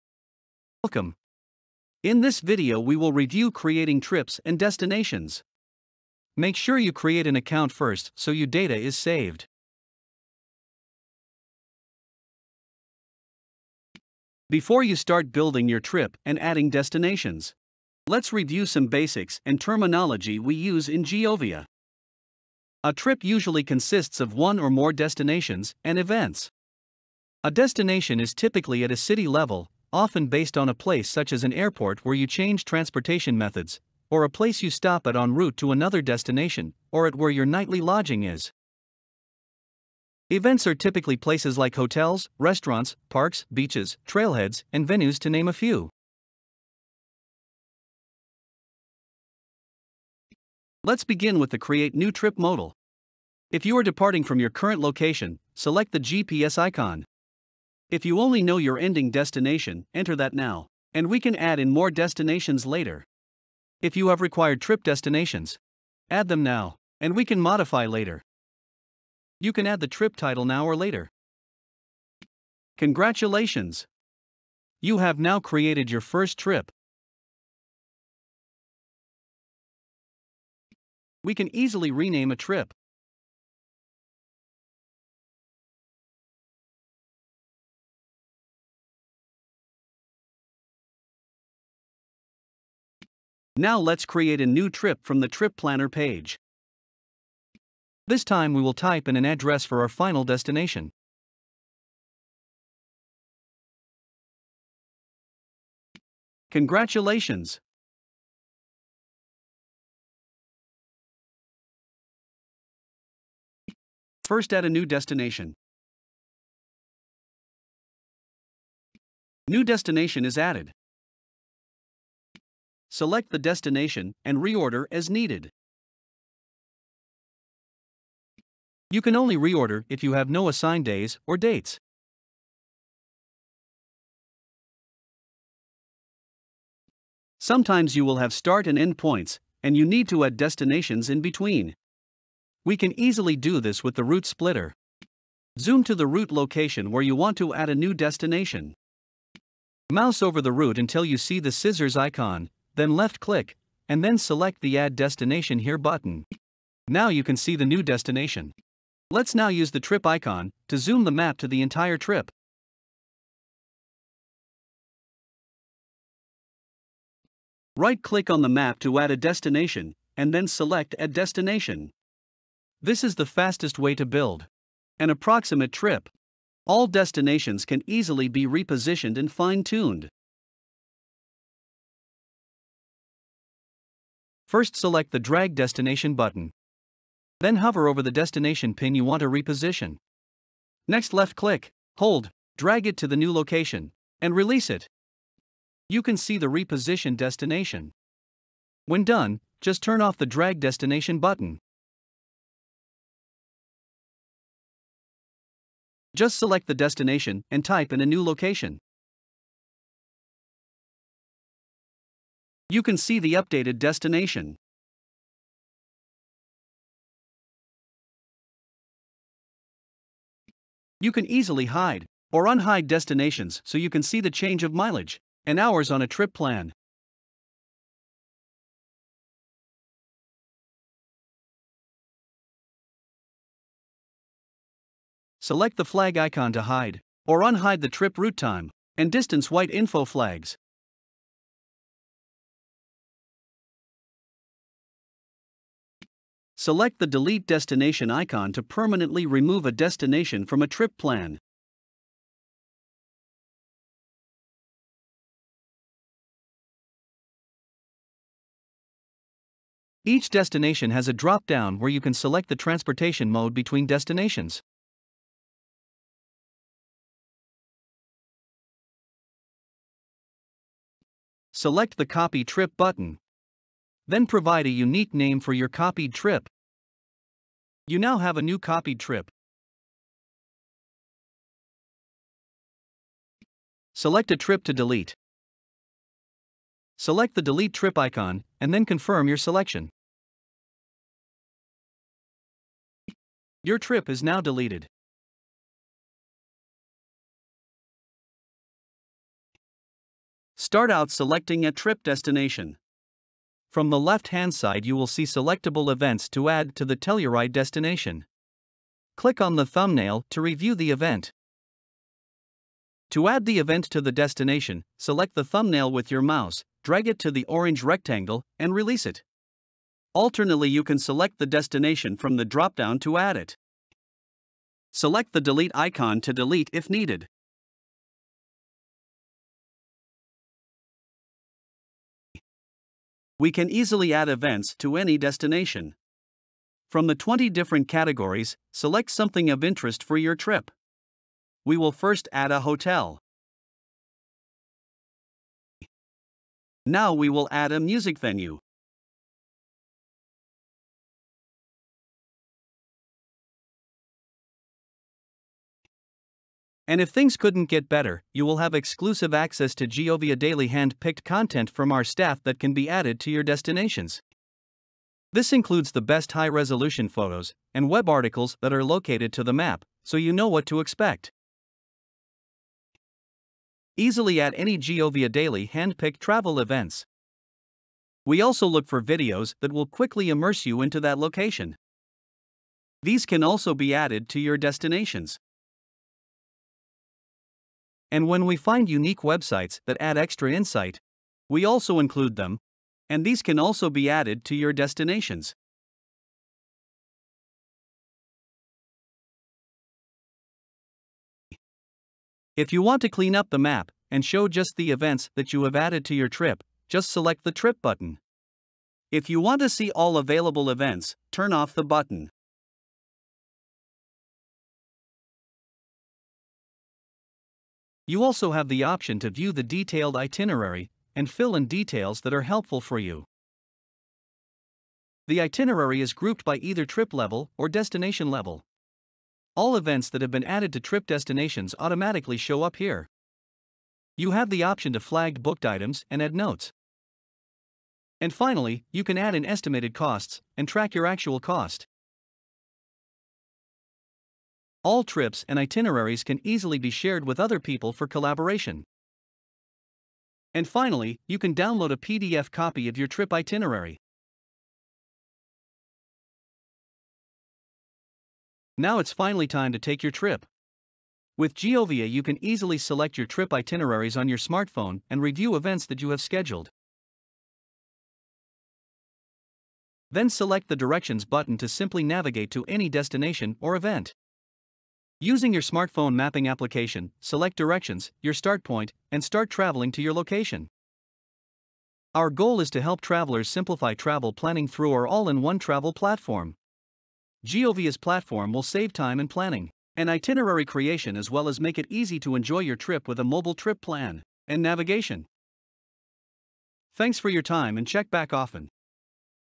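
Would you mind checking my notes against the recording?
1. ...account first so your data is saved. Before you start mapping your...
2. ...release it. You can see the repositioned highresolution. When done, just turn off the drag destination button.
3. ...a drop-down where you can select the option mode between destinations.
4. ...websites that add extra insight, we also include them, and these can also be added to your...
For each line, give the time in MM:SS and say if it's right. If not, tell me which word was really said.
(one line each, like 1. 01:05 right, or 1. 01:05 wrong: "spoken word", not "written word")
1. 00:07 wrong: "building", not "mapping"
2. 03:14 wrong: "destination", not "highresolution"
3. 04:21 wrong: "transportation", not "option"
4. 06:29 right.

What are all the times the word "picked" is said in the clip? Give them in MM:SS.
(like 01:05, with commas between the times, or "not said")
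06:00, 06:15.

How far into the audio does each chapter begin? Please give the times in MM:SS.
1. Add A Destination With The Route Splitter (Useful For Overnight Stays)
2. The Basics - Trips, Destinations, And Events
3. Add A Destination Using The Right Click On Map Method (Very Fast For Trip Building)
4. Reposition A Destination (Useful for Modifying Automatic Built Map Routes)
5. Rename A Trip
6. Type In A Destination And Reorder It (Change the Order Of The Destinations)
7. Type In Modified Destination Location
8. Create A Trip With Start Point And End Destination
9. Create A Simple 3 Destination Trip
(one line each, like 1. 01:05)
1. 02:13
2. 00:10
3. 02:43
4. 03:00
5. 01:17
6. 01:48
7. 03:21
8. 01:29
9. 00:46.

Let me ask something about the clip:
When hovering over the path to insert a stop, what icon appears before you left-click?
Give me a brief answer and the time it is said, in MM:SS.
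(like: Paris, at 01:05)
scissors icon, at 02:31.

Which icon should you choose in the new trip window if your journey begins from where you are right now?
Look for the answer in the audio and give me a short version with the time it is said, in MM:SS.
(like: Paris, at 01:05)
GPS icon, at 00:55.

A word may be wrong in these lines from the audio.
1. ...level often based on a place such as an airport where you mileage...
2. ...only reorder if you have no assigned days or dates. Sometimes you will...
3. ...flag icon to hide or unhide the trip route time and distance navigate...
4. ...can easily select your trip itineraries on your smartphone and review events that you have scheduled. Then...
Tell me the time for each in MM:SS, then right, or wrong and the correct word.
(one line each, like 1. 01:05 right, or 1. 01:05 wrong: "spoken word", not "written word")
1. 00:29 wrong: "change", not "mileage"
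2. 02:09 right
3. 03:55 wrong: "white", not "navigate"
4. 07:42 right.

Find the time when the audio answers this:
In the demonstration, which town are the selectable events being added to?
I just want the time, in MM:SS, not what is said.
05:06.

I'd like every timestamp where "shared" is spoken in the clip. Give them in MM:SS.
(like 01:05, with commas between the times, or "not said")
07:26.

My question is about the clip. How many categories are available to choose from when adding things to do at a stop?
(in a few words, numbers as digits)
20.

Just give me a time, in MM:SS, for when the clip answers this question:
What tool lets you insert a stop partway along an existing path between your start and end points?
02:24.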